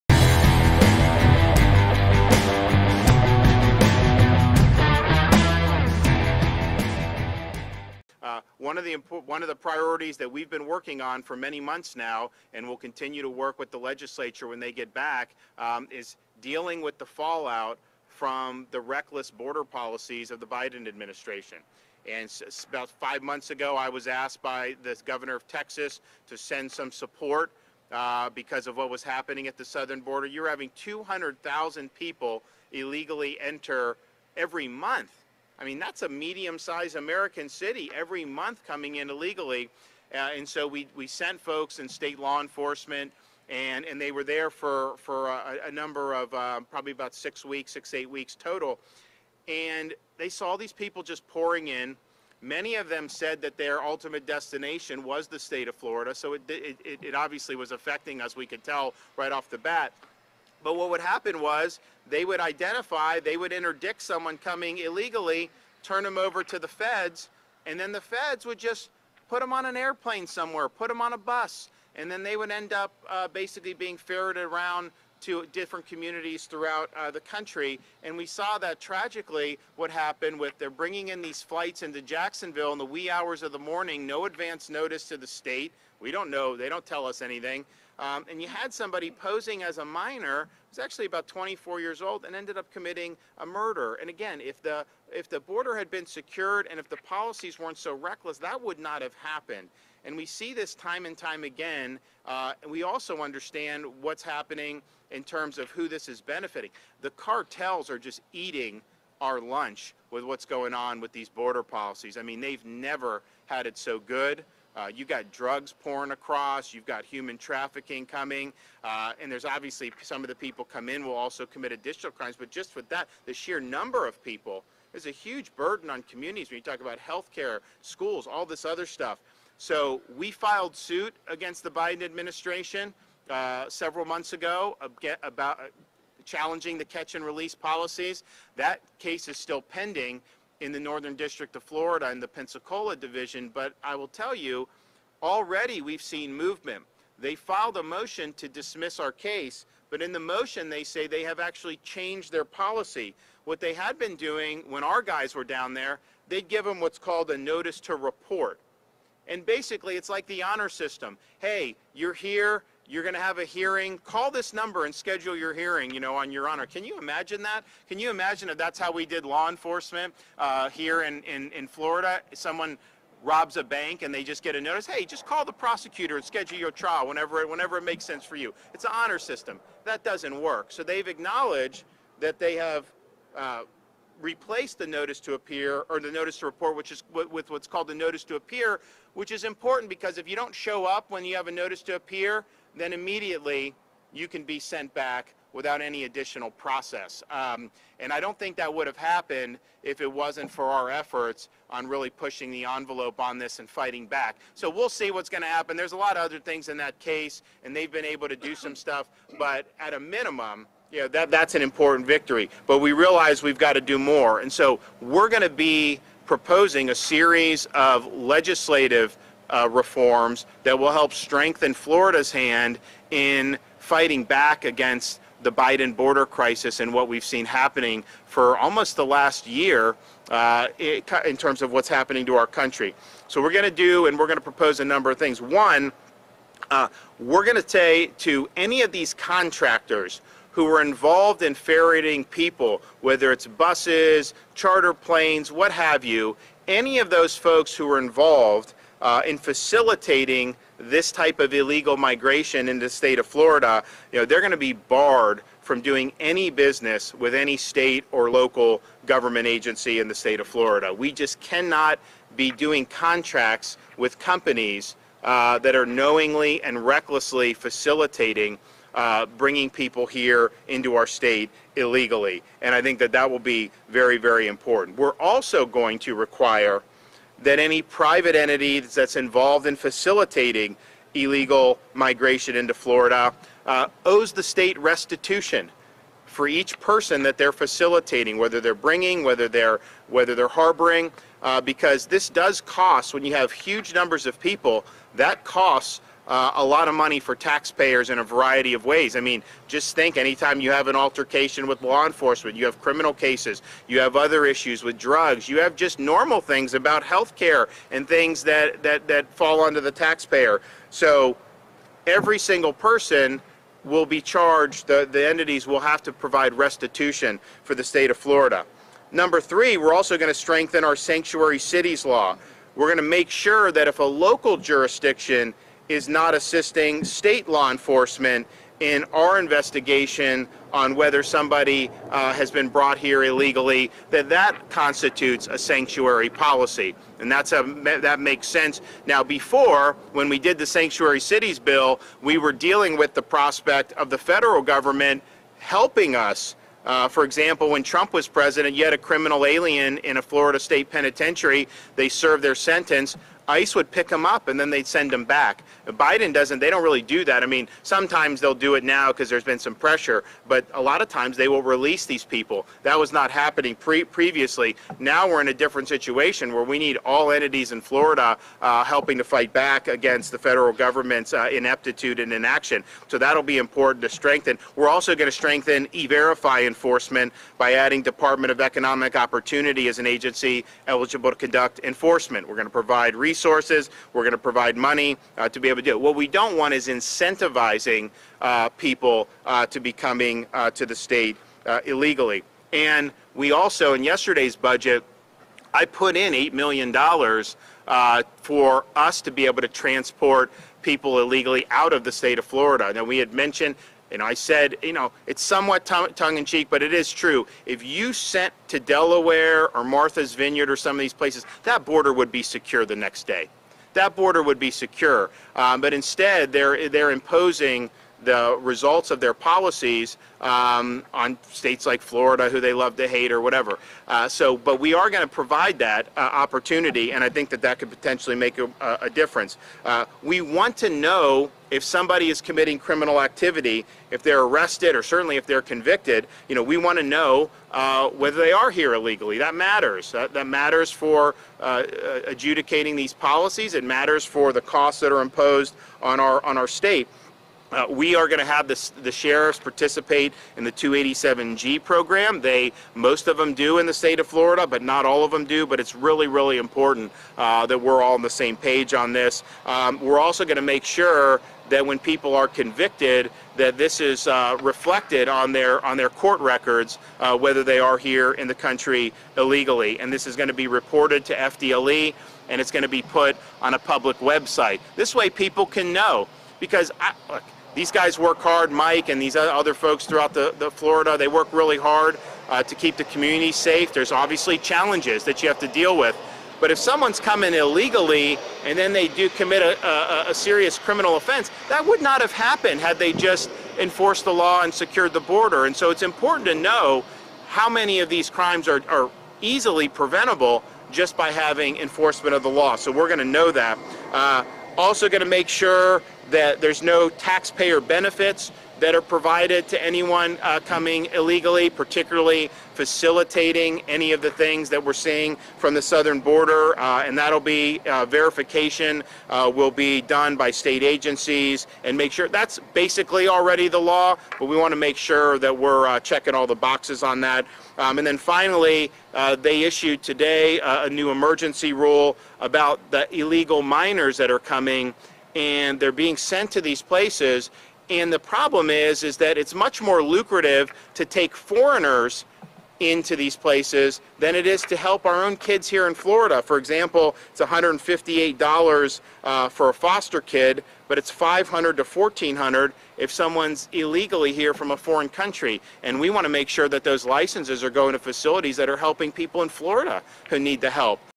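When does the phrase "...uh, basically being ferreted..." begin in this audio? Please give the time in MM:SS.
01:13.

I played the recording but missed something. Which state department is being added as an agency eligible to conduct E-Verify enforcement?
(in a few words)
Department of Economic Opportunity.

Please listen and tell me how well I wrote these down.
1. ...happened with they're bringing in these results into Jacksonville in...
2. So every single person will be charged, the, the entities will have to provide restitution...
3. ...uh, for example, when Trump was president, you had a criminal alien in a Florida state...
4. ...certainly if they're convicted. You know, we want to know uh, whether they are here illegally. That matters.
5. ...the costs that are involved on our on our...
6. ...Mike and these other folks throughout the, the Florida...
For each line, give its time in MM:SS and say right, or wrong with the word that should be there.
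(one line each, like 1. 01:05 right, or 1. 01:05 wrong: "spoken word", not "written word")
1. 01:19 wrong: "flights", not "results"
2. 05:10 right
3. 05:46 right
4. 07:15 right
5. 07:24 wrong: "imposed", not "involved"
6. 07:58 right.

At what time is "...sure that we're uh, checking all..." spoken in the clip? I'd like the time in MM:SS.
08:44.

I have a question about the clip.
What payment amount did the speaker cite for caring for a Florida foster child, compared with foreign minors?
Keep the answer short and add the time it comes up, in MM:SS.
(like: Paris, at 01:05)
$158, at 09:07.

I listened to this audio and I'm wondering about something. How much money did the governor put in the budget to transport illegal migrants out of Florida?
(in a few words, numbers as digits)
$8 million.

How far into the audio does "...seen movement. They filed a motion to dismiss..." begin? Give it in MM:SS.
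02:26.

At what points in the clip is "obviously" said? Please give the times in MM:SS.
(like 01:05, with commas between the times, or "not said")
00:57, 01:59, 08:04.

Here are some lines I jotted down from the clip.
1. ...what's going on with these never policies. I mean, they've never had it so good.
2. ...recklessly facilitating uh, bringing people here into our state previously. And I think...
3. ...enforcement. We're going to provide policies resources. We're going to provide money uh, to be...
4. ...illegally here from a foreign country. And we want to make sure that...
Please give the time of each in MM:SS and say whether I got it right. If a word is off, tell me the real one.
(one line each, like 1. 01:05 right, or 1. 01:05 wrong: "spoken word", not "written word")
1. 01:50 wrong: "border", not "never"
2. 04:26 wrong: "illegally", not "previously"
3. 06:21 wrong: "resources", not "policies"
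4. 09:13 right.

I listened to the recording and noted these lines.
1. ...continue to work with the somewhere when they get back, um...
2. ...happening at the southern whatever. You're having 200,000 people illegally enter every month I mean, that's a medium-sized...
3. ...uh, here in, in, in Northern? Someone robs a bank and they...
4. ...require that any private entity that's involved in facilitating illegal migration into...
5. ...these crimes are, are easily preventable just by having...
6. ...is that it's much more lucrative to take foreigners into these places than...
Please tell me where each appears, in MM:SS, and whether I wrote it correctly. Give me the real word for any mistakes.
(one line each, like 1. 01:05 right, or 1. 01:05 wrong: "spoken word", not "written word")
1. 00:12 wrong: "legislature", not "somewhere"
2. 00:29 wrong: "border", not "whatever"
3. 02:50 wrong: "Florida", not "Northern"
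4. 04:36 right
5. 08:18 right
6. 08:59 right.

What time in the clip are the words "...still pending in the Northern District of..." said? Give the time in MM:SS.
02:19.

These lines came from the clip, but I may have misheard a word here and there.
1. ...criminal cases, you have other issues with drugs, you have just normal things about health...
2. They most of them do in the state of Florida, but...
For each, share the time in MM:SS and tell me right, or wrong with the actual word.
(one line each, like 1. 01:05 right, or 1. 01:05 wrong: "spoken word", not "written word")
1. 05:02 right
2. 07:32 right.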